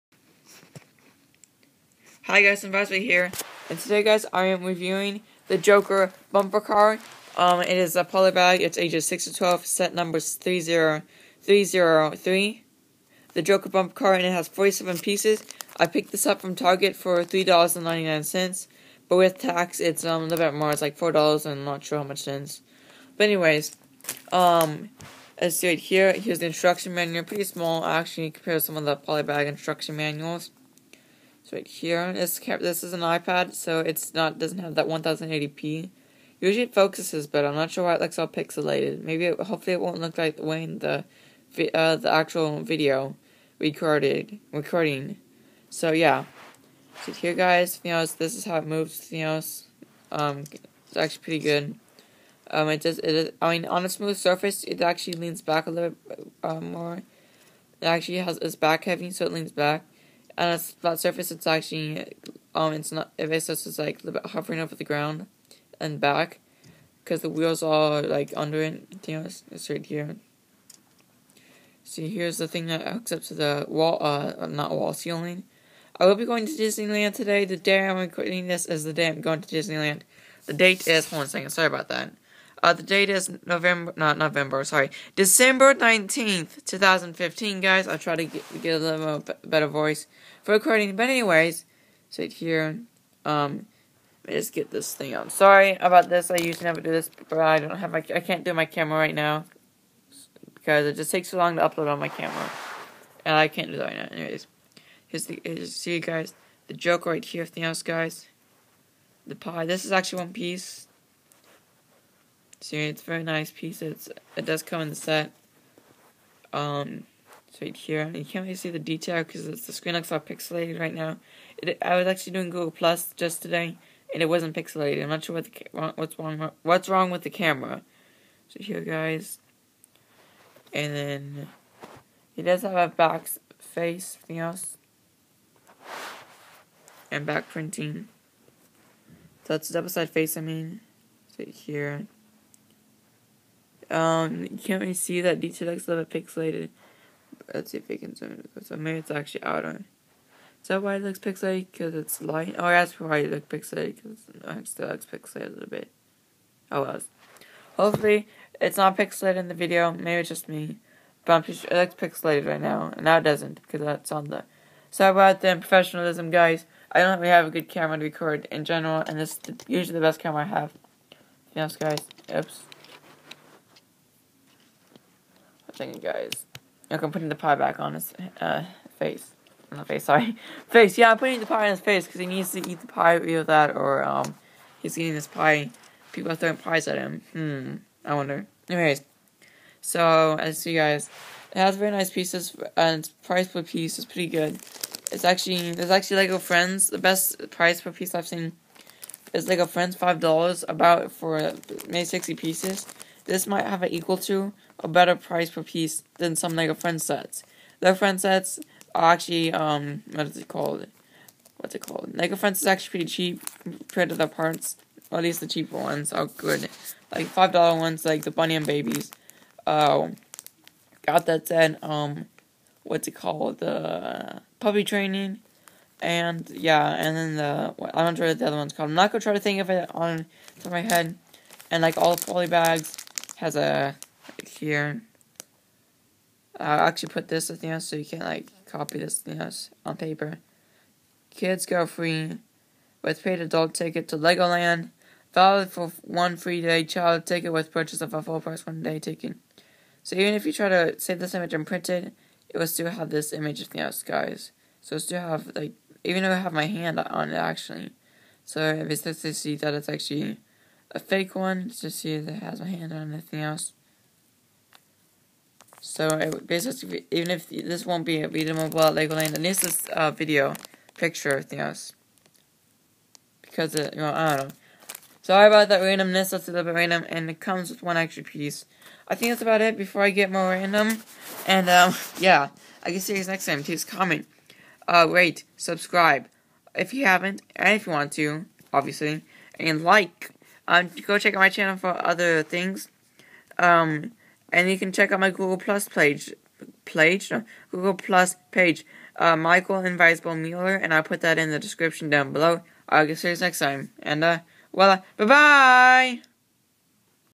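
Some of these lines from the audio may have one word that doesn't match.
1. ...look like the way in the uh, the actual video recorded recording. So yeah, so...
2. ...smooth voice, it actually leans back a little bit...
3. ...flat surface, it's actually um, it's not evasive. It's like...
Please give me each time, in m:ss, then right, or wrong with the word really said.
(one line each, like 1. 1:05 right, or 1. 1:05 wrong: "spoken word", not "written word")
1. 0:39 right
2. 0:53 wrong: "surface", not "voice"
3. 1:00 right.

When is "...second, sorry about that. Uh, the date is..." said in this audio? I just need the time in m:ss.
1:21.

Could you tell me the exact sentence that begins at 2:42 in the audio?
And now it doesn't, because that's on the...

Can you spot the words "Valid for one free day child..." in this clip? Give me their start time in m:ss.
4:05.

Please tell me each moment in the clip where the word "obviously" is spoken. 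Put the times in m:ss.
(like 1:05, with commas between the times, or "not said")
4:48.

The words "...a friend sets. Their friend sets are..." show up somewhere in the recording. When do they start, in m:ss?
3:26.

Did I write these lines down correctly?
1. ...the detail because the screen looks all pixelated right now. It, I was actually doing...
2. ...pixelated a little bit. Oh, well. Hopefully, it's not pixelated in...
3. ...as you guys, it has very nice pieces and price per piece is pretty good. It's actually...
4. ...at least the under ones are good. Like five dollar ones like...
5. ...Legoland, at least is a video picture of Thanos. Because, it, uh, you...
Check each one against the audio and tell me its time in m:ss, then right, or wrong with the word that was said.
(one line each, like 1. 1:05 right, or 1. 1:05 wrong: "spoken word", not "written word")
1. 1:58 right
2. 2:35 right
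3. 3:10 right
4. 3:35 wrong: "cheaper", not "under"
5. 4:28 right.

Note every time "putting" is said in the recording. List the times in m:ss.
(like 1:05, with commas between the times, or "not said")
2:57, 3:01.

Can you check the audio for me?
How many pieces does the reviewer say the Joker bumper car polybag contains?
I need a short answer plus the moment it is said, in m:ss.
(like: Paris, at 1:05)
47, at 0:14.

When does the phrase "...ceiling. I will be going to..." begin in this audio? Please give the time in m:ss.
1:14.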